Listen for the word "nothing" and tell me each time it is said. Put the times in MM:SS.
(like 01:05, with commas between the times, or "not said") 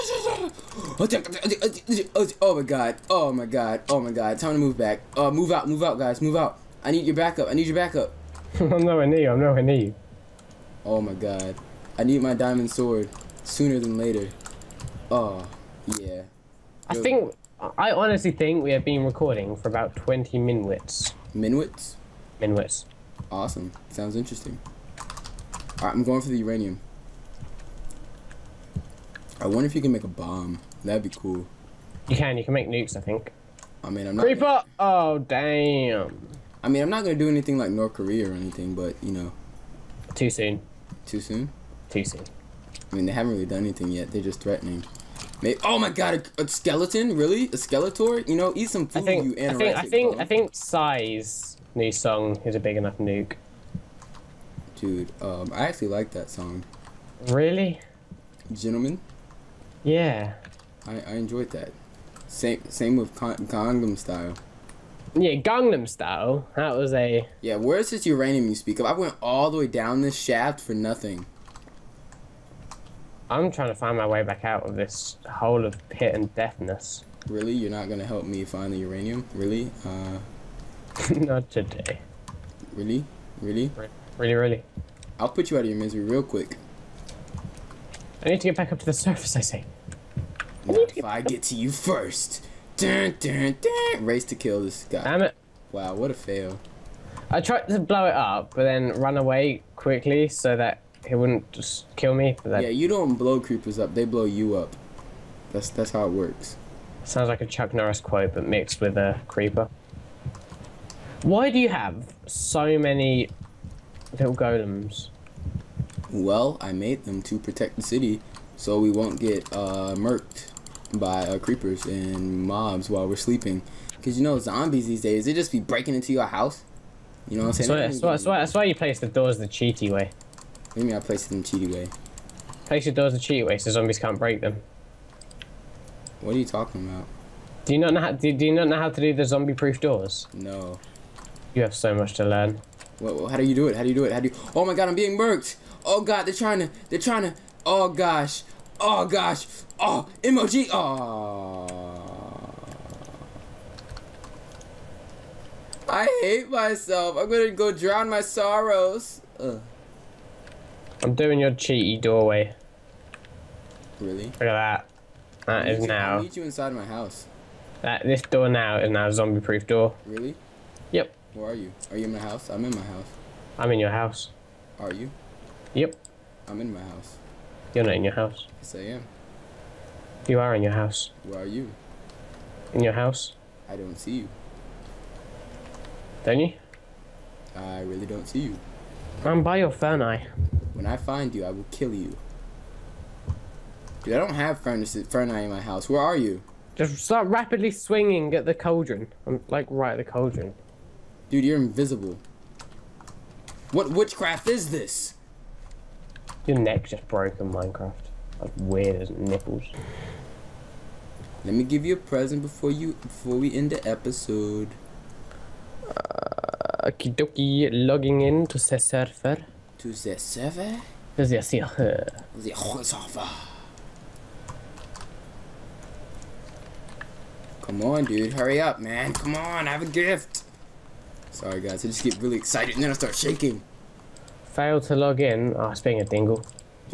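01:10.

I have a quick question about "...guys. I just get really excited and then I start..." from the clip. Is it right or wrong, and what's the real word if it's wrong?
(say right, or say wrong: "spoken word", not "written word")
right.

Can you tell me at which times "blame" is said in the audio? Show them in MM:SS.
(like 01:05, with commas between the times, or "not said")
not said.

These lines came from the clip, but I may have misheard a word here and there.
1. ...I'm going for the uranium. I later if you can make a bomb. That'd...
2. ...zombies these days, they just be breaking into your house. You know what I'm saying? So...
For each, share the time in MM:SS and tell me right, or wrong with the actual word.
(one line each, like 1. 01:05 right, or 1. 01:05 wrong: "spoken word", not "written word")
1. 00:25 wrong: "wonder", not "later"
2. 02:04 right.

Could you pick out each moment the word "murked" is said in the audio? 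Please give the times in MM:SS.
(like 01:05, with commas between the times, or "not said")
01:59, 02:25.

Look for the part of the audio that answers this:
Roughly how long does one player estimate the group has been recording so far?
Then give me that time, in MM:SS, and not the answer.
00:19.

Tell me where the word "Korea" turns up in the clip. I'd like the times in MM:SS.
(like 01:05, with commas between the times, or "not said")
00:37.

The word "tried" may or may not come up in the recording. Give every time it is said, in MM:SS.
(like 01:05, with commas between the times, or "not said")
01:37.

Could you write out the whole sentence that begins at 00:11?
I need my diamond sword sooner than later.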